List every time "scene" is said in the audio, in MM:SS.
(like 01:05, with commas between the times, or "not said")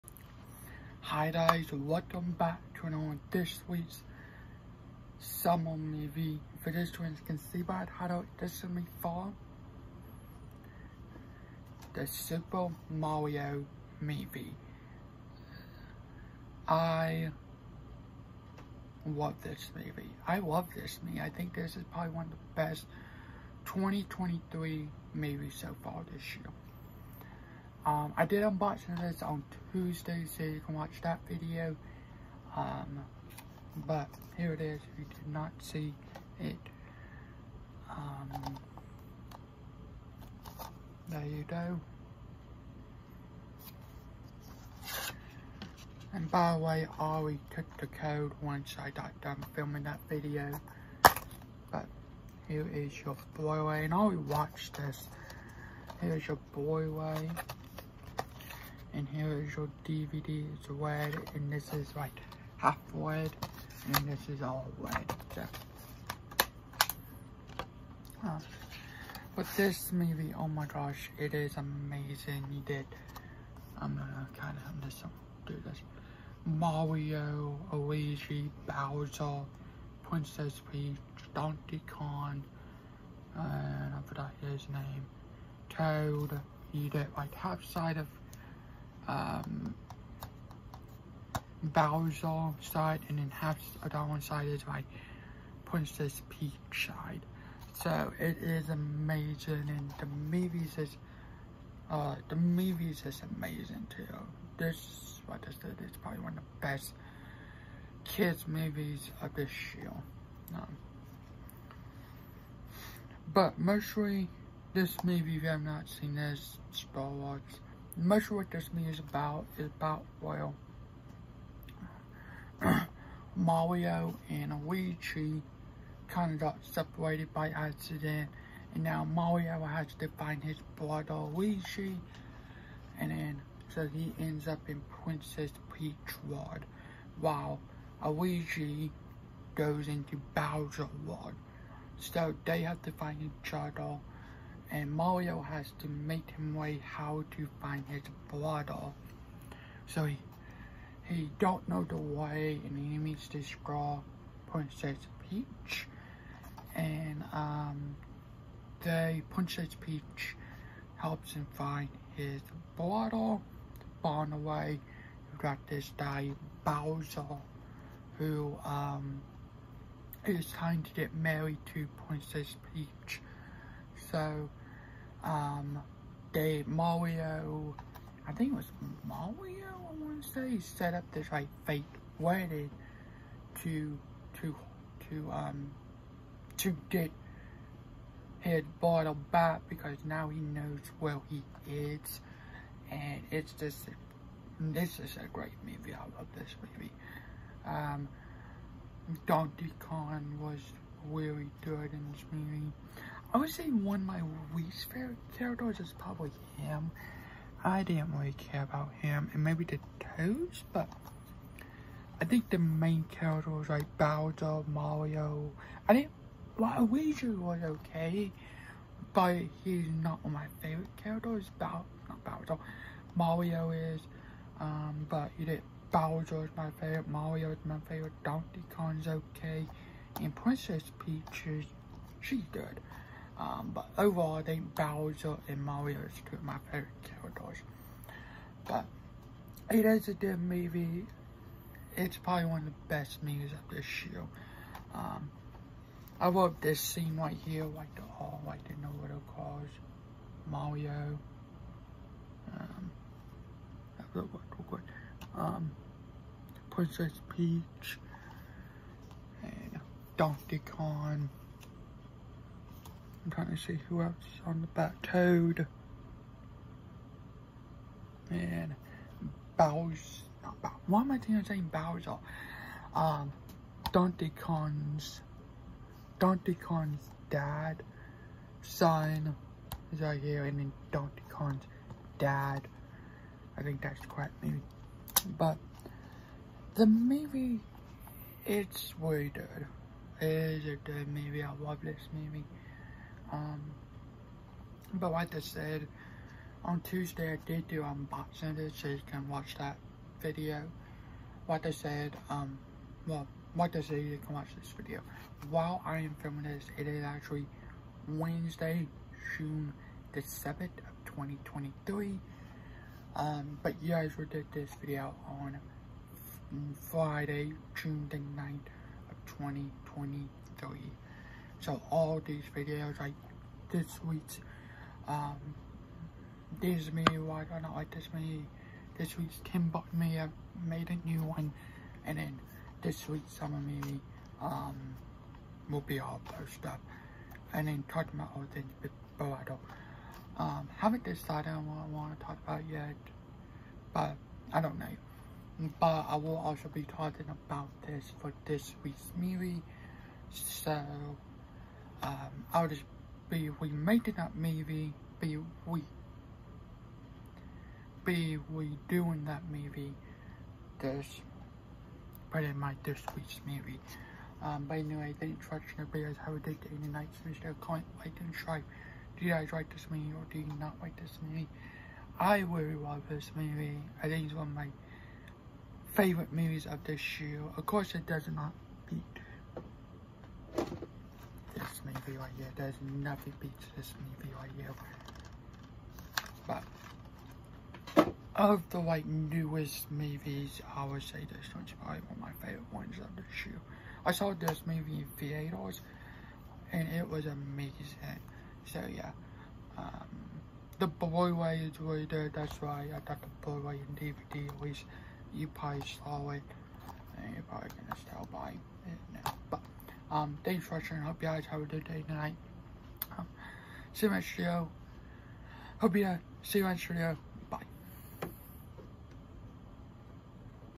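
04:06.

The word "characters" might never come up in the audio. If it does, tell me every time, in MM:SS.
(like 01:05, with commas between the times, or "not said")
03:25, 03:33, 03:41, 03:57.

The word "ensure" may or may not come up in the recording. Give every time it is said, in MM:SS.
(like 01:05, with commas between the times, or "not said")
not said.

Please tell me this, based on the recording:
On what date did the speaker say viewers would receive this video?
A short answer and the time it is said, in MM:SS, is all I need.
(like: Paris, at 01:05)
Friday, June 9, 2023, at 05:16.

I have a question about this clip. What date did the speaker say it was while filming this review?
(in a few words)
Wednesday, June 7, 2023.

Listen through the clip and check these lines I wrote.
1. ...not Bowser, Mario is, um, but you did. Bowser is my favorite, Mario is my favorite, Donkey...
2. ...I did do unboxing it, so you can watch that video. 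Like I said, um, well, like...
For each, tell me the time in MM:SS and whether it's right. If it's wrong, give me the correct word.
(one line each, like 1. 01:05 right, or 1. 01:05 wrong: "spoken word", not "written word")
1. 03:42 right
2. 04:57 right.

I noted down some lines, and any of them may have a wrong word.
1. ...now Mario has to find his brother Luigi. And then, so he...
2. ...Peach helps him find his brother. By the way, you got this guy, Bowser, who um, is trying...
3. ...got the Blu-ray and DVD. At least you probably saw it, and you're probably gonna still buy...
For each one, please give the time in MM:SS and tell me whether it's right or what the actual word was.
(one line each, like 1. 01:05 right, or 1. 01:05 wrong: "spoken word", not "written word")
1. 02:08 right
2. 02:39 right
3. 06:43 right.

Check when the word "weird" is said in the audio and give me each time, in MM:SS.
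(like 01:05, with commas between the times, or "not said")
04:48.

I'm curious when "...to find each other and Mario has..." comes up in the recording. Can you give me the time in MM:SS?
02:22.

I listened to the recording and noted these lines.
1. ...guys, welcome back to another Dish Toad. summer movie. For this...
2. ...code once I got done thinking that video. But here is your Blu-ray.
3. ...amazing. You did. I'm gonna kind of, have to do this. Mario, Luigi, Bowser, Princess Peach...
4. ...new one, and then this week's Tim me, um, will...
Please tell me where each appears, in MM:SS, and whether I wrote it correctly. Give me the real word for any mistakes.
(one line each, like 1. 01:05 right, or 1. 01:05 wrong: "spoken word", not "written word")
1. 00:01 wrong: "Sweets", not "Toad"
2. 00:47 wrong: "filming", not "thinking"
3. 01:11 right
4. 05:31 wrong: "Summer", not "Tim".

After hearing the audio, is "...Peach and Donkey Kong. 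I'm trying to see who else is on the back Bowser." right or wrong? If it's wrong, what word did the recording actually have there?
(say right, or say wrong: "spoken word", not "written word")
wrong: "Toad", not "Bowser".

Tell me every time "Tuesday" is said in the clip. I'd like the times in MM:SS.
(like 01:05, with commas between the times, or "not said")
00:29, 04:56.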